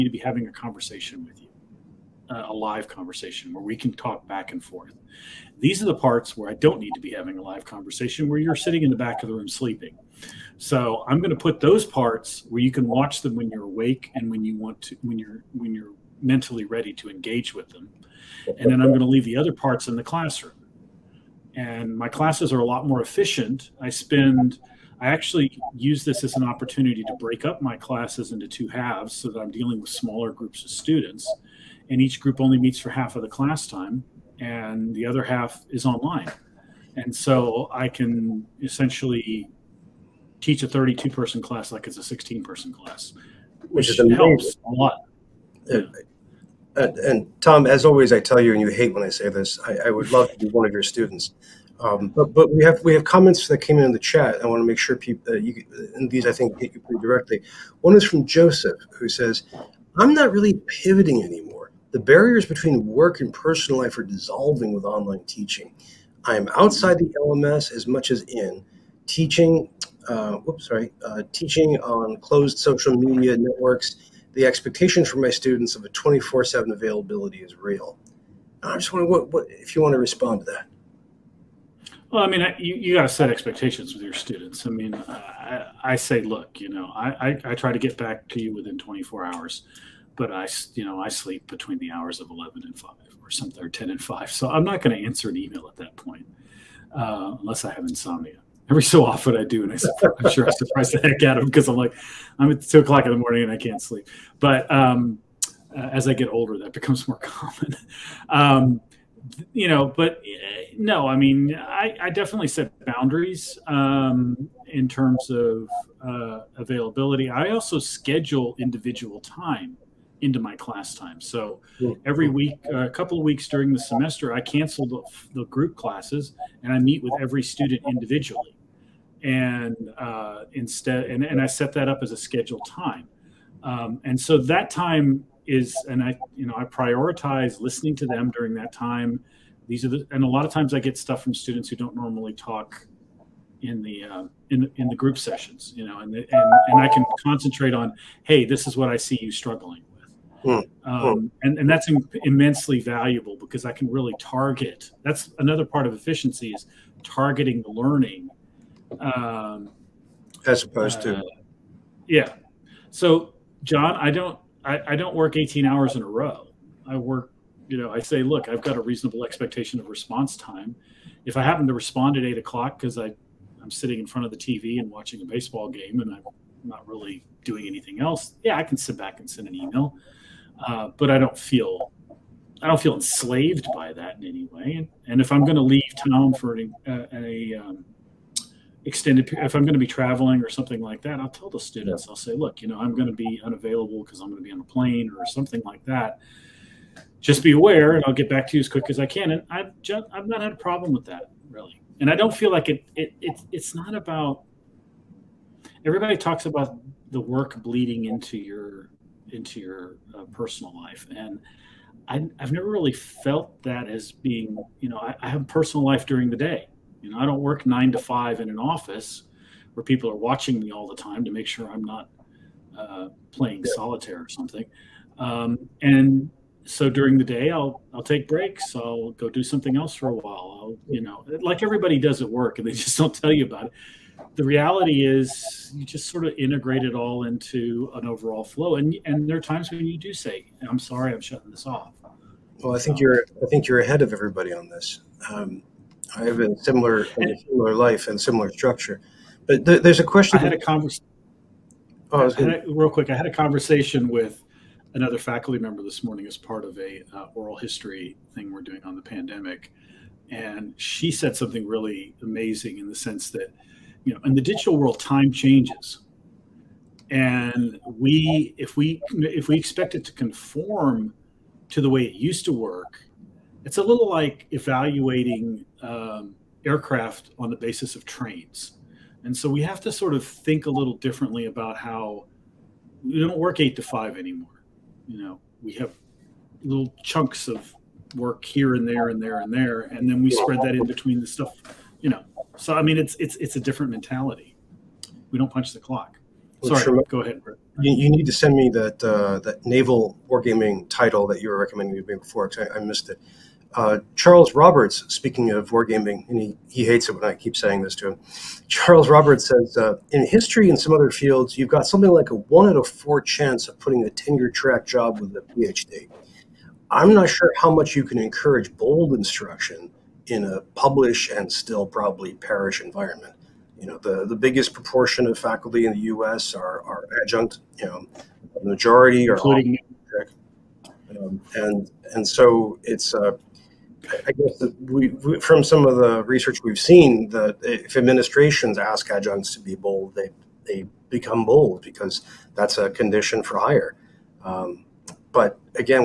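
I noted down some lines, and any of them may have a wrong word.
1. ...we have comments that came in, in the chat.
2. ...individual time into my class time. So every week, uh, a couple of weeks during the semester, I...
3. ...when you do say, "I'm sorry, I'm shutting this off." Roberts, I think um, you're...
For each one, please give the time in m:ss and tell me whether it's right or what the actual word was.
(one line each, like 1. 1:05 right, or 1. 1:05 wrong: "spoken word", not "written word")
1. 0:52 right
2. 1:58 right
3. 3:59 wrong: "Well", not "Roberts".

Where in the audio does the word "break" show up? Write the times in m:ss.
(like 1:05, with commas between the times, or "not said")
0:27, 3:48.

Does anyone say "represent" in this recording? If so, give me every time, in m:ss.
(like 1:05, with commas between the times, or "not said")
not said.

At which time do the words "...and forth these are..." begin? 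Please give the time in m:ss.
0:04.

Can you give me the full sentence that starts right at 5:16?
I'm not sure how much you can encourage bold instruction in a publish and still probably perish environment.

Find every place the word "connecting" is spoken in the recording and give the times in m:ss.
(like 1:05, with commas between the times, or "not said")
not said.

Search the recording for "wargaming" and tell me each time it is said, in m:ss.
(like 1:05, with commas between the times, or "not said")
5:00, 5:05.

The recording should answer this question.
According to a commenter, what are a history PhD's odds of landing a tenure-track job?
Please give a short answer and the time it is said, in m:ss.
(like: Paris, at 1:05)
one out of four, at 5:12.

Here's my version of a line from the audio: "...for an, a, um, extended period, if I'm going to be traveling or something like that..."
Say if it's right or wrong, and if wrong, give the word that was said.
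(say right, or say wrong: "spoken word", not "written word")
right.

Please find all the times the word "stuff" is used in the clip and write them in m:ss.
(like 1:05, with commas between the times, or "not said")
2:20, 4:51.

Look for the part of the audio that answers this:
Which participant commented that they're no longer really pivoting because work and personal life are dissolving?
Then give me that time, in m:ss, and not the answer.
0:58.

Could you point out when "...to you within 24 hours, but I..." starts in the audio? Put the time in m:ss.
1:28.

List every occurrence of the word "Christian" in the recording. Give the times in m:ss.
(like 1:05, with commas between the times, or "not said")
not said.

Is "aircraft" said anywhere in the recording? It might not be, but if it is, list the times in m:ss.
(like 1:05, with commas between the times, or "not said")
4:36.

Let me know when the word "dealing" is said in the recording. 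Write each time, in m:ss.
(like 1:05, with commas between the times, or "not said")
0:29.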